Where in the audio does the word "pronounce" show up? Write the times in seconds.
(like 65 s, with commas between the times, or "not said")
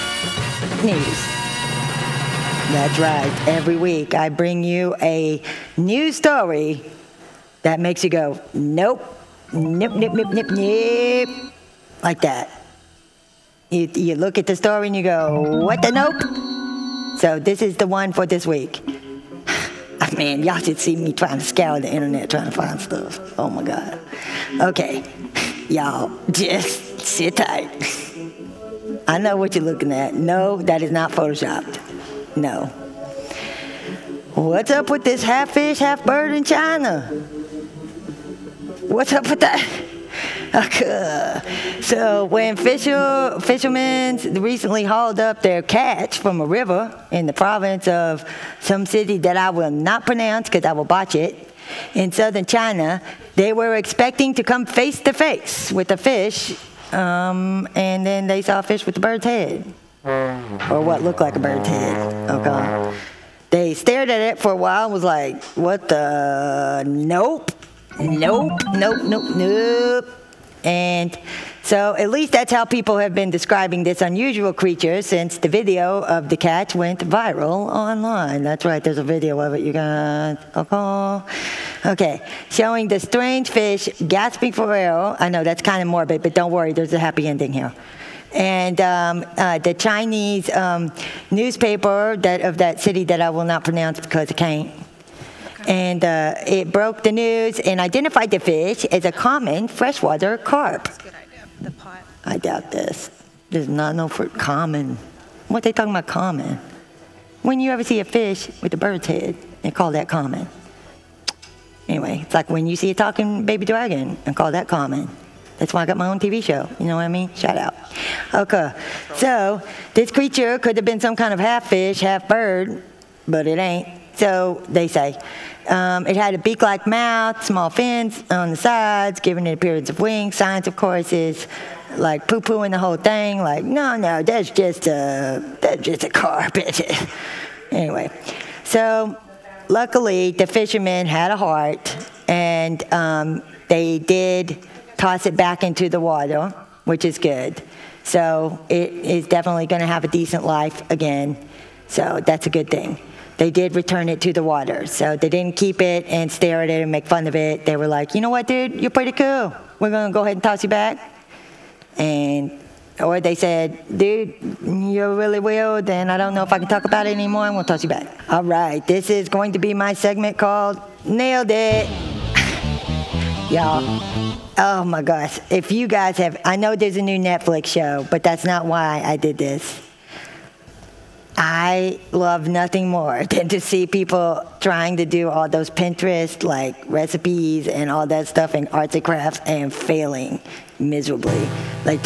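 50 s, 93 s.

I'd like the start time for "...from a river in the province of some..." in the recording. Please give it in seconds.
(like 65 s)
46 s.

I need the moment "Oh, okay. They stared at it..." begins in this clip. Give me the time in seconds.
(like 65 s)
62 s.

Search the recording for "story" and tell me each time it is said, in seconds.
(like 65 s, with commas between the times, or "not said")
6 s, 14 s.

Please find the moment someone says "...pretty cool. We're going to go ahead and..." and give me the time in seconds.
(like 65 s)
158 s.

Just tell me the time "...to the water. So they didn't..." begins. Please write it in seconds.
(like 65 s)
154 s.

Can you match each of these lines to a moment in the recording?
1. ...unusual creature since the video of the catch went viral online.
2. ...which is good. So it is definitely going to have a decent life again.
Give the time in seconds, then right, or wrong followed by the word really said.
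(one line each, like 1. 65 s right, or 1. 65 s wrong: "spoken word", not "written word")
1. 74 s right
2. 146 s right.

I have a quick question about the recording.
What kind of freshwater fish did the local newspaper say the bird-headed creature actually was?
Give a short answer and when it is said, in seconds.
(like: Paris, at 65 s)
common freshwater carp, at 99 s.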